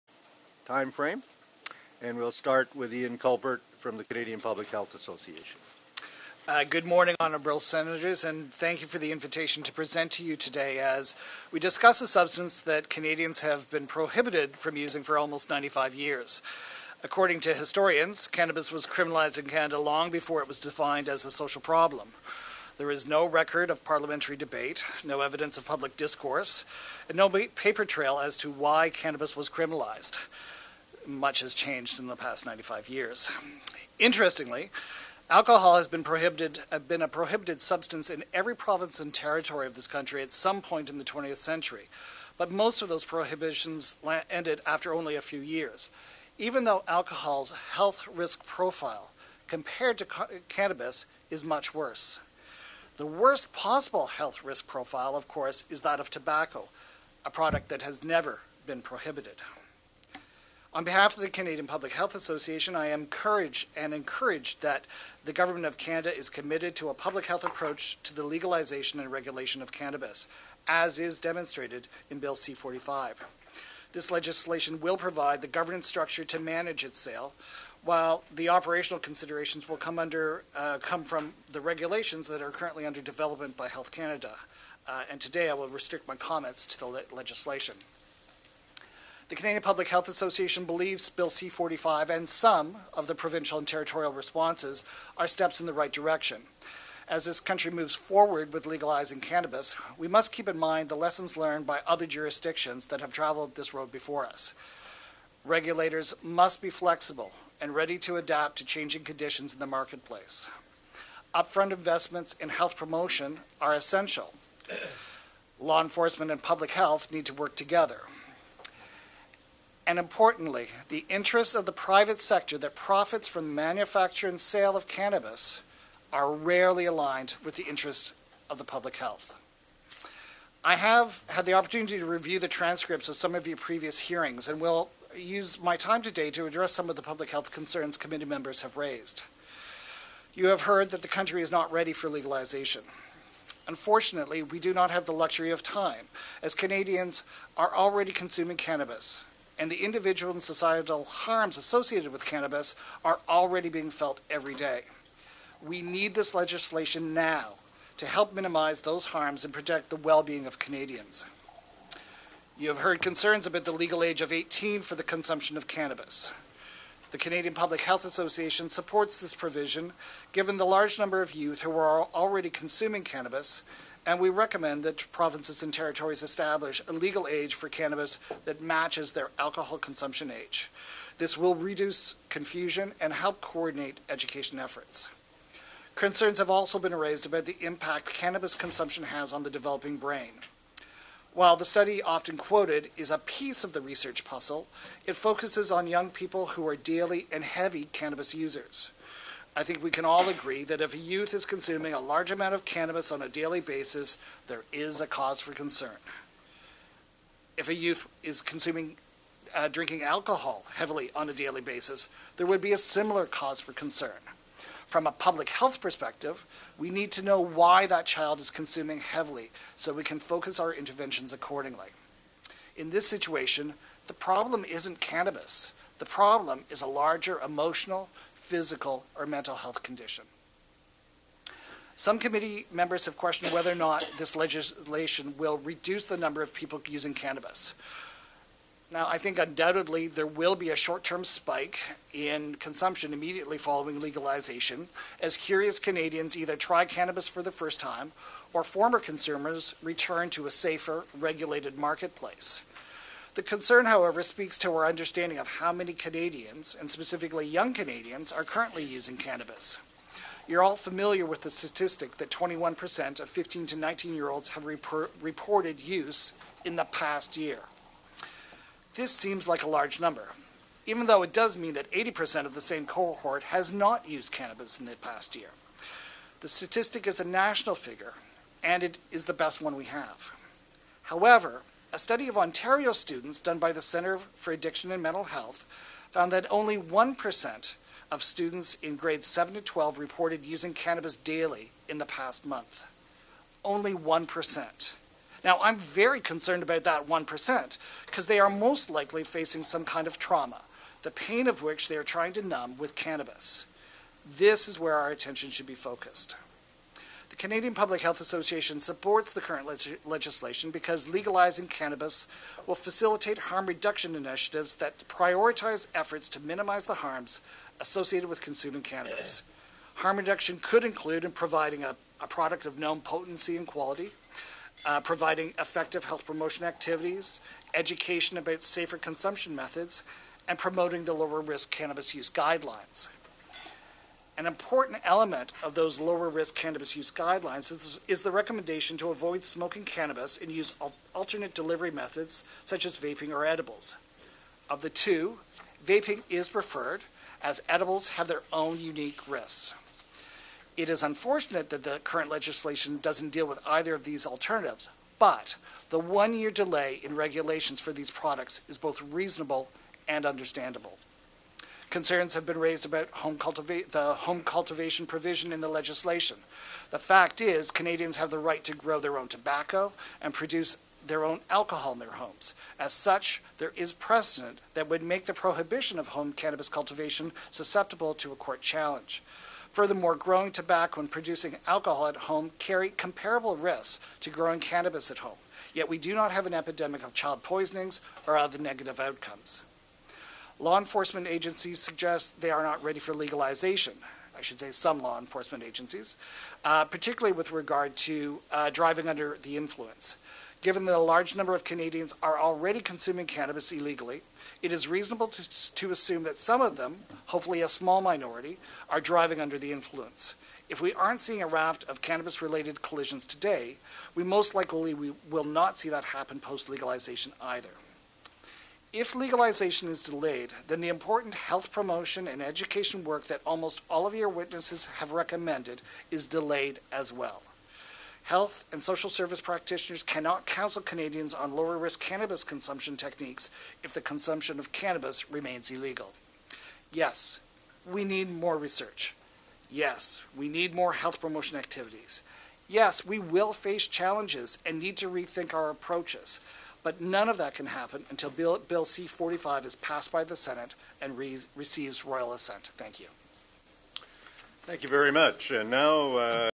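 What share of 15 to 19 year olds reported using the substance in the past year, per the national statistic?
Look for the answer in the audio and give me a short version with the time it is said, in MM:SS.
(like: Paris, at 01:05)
21%, at 04:22.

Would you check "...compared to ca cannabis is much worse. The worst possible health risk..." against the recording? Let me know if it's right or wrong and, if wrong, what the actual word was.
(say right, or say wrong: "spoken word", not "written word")
right.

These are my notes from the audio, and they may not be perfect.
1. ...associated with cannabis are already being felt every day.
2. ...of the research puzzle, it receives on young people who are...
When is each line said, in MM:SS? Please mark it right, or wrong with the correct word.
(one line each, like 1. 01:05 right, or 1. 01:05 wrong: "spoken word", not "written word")
1. 02:31 right
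2. 03:13 wrong: "focuses", not "receives".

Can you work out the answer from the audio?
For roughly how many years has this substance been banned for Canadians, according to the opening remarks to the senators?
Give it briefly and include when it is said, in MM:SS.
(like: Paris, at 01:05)
95 years, at 00:15.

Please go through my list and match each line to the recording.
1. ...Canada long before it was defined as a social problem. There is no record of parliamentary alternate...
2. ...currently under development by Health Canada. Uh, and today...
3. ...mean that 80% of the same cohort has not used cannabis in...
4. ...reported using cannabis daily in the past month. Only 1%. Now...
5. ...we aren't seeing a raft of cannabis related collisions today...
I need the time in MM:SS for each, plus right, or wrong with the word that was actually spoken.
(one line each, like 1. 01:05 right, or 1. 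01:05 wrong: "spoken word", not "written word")
1. 00:19 wrong: "debate", not "alternate"
2. 01:22 right
3. 04:31 right
4. 04:49 right
5. 06:50 right.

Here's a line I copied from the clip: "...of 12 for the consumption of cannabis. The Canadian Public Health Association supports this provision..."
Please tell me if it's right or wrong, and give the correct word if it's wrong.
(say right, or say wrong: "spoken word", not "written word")
wrong: "18", not "12".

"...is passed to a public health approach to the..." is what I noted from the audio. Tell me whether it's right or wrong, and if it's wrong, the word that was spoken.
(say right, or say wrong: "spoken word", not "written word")
wrong: "committed", not "passed".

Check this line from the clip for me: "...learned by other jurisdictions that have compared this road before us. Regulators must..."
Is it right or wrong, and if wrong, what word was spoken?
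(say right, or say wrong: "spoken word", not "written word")
wrong: "traveled", not "compared".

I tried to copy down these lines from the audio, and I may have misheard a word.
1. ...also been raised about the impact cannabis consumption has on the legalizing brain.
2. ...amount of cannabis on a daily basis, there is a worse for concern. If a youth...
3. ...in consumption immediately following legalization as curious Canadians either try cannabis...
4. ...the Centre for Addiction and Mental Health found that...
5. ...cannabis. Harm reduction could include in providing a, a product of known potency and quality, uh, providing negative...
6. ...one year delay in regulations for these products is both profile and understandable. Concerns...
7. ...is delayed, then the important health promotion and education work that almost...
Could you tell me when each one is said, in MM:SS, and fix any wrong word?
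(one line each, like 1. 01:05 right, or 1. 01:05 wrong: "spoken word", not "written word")
1. 03:06 wrong: "developing", not "legalizing"
2. 03:22 wrong: "cause", not "worse"
3. 04:02 right
4. 04:43 right
5. 05:18 wrong: "effective", not "negative"
6. 05:55 wrong: "reasonable", not "profile"
7. 06:59 right.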